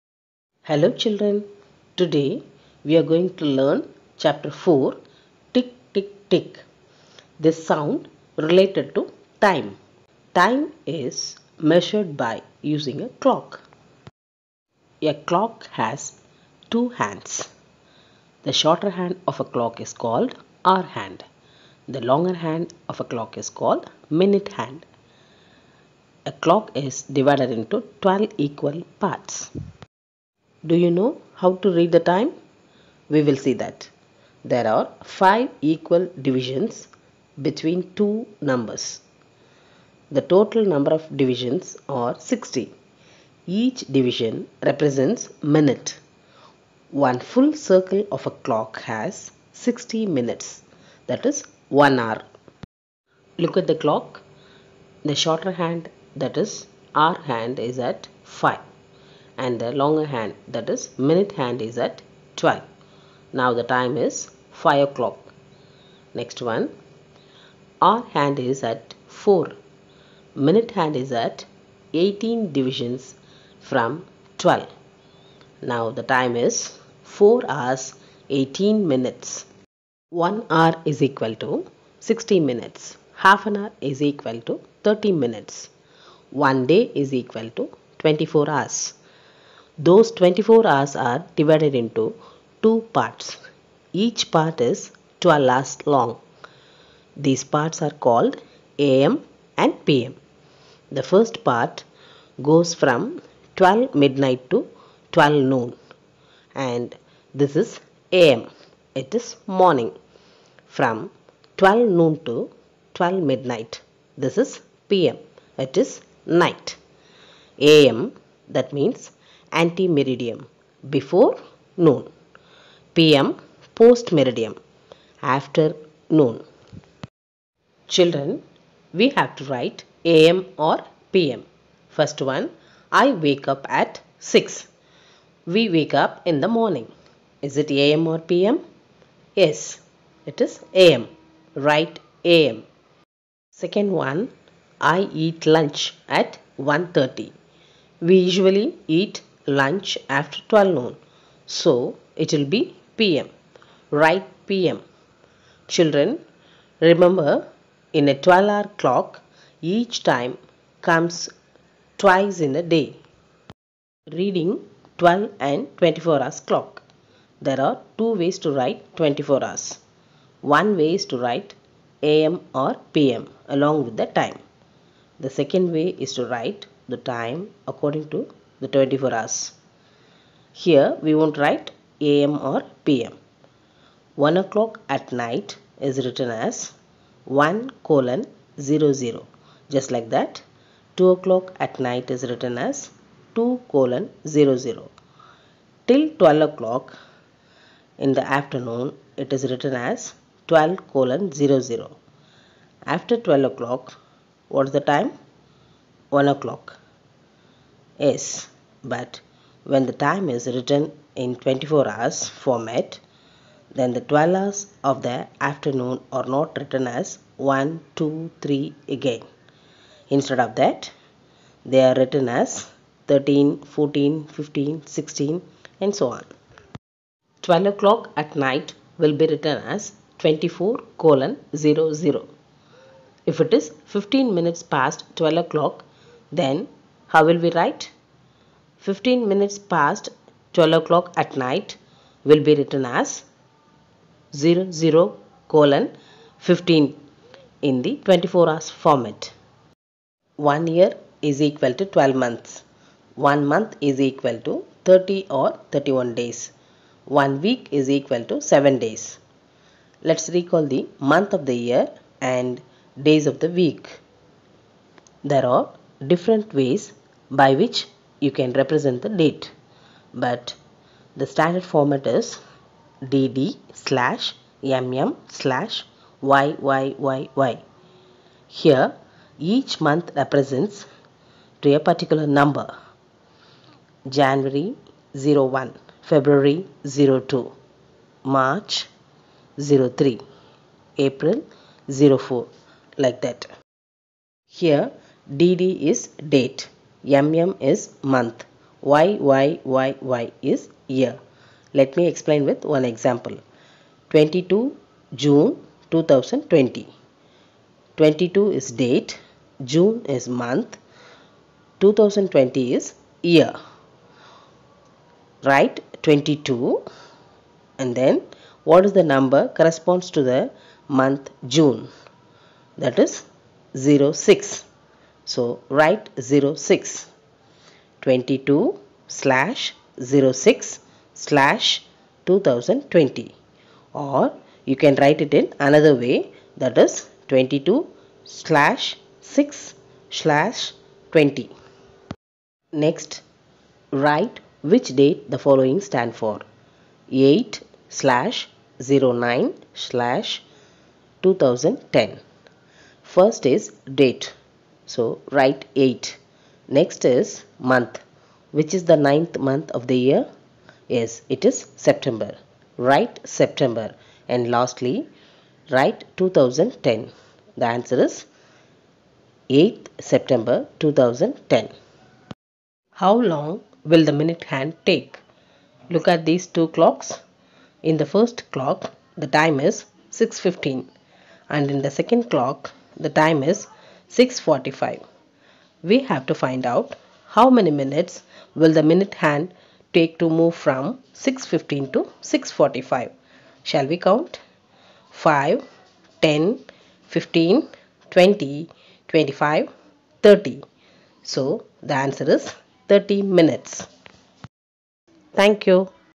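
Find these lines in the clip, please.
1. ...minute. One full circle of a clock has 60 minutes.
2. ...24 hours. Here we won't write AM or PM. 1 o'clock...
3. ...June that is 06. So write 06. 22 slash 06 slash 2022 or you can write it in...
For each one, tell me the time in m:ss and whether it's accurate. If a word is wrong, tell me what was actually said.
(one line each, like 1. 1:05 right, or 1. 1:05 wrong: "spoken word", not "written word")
1. 0:45 right
2. 2:58 right
3. 5:21 wrong: "2020", not "2022".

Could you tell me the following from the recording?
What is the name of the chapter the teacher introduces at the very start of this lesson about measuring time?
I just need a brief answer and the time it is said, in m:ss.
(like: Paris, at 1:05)
Tick tick tick, at 0:05.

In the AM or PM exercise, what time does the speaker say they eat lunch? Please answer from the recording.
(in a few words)
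1:30.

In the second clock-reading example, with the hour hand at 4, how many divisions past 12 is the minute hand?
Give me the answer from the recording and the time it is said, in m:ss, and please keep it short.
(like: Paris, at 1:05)
18, at 1:12.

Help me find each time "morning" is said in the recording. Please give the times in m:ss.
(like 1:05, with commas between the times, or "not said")
1:49, 2:16.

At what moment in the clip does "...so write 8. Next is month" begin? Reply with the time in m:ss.
5:54.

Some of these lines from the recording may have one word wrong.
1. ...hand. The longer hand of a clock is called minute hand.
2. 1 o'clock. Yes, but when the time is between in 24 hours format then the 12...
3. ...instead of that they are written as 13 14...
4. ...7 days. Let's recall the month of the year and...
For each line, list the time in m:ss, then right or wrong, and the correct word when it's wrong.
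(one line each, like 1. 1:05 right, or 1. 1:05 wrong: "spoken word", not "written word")
1. 0:20 right
2. 3:26 wrong: "written", not "between"
3. 3:40 right
4. 4:18 right.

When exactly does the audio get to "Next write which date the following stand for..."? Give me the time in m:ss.
5:42.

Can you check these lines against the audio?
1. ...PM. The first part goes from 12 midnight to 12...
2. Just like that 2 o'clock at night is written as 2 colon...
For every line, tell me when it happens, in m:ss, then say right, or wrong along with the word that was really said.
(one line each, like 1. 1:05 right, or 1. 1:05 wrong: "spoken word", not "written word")
1. 1:39 right
2. 3:09 right.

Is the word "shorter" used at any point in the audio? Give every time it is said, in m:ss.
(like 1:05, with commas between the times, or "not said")
0:18, 0:55.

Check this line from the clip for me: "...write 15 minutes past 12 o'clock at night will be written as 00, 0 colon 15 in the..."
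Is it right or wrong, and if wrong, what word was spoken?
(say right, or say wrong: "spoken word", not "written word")
right.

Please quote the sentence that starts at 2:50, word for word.
One way is to write AM or PM along with the time.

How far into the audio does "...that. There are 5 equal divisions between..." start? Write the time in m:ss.
0:33.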